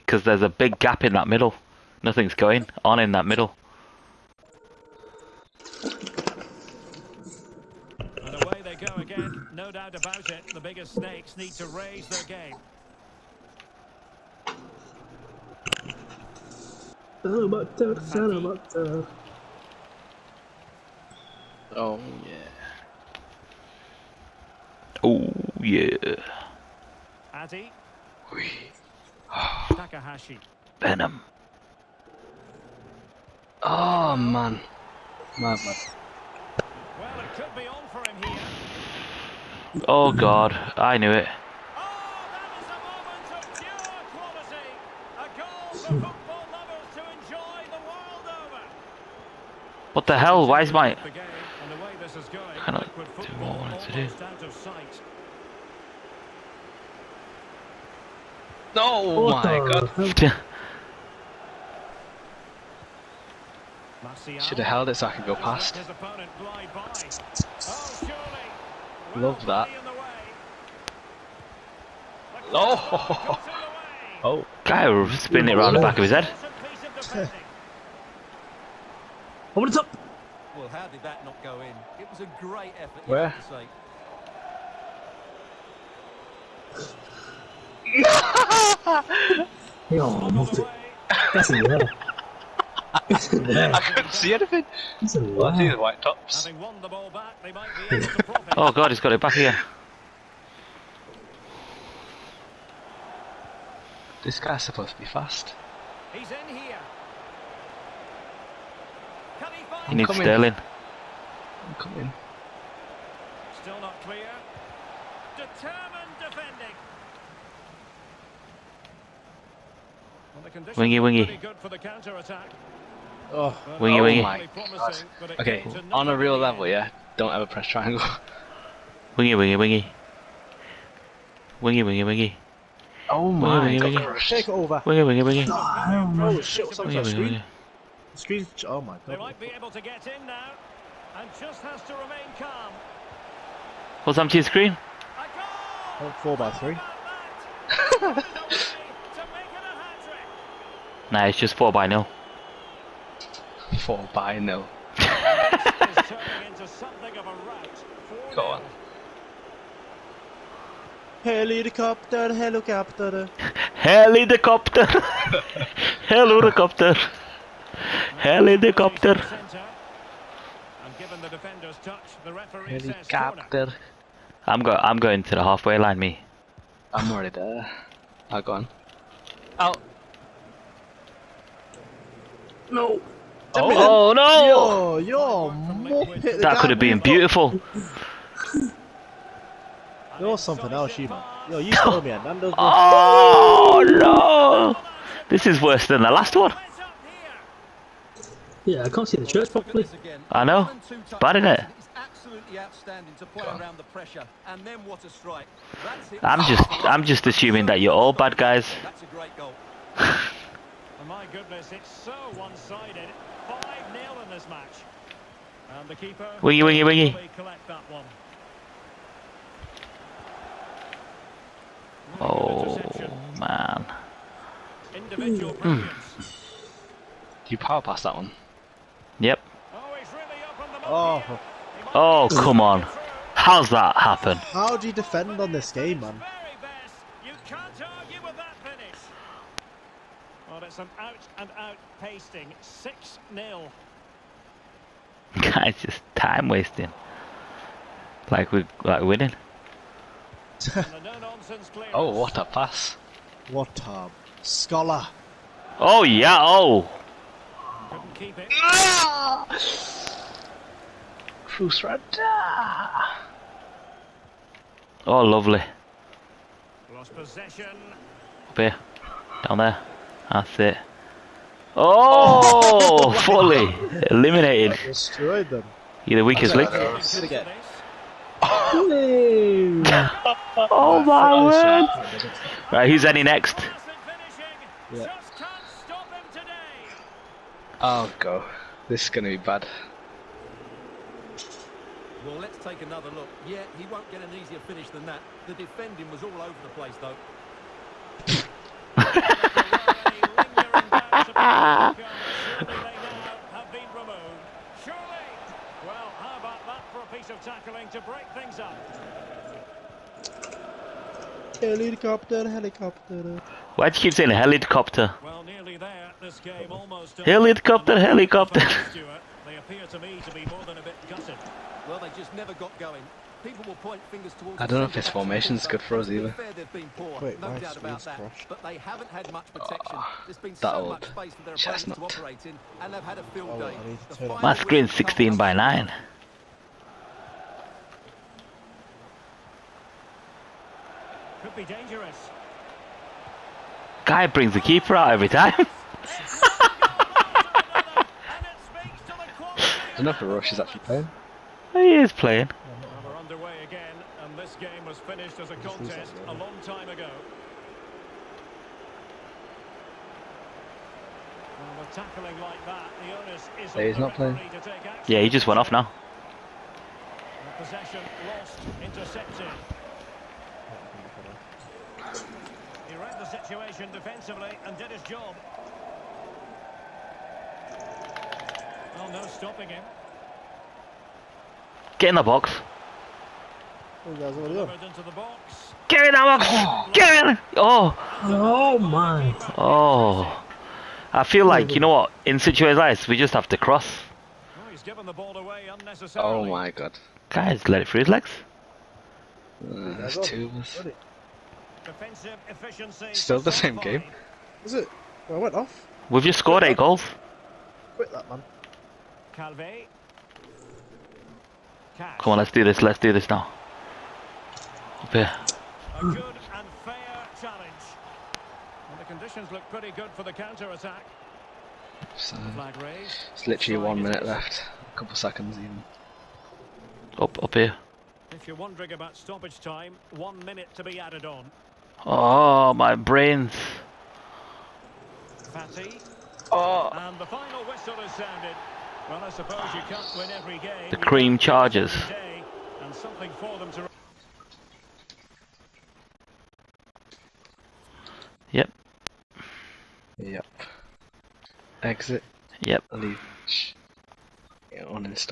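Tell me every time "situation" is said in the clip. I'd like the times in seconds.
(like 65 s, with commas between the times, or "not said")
373 s, 392 s.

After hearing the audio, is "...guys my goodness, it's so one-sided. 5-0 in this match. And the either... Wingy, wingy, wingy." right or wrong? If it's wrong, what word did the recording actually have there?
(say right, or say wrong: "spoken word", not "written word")
wrong: "keeper", not "either".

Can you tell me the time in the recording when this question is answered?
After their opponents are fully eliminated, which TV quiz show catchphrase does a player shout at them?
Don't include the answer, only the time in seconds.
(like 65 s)
276 s.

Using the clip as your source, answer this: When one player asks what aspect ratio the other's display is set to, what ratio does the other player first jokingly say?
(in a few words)
4 by 3.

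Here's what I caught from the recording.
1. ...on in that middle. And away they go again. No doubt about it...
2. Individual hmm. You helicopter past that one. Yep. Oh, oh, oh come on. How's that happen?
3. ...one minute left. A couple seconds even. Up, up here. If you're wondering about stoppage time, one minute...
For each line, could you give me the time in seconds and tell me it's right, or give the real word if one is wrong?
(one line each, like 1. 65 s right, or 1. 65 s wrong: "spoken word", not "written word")
1. 2 s right
2. 224 s wrong: "power", not "helicopter"
3. 423 s right.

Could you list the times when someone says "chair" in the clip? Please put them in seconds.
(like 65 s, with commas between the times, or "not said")
not said.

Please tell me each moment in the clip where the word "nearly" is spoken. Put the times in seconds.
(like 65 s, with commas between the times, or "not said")
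315 s.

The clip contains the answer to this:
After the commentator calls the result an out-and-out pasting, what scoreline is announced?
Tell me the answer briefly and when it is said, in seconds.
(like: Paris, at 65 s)
6-0, at 242 s.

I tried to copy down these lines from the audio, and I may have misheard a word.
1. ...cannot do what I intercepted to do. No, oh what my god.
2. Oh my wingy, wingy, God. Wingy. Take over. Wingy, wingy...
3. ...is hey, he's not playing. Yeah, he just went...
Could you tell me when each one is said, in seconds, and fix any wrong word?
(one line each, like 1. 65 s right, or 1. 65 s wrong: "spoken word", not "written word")
1. 52 s wrong: "wanted", not "intercepted"
2. 133 s right
3. 363 s right.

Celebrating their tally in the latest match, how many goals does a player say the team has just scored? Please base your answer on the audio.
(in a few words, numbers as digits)
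8.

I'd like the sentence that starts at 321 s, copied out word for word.
Well, they just never got going.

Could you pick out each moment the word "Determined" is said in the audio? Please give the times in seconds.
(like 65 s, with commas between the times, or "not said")
115 s.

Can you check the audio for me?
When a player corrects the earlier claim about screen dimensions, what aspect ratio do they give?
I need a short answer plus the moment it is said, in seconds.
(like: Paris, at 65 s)
16 by 9, at 334 s.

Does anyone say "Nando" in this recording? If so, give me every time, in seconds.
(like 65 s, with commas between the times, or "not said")
192 s.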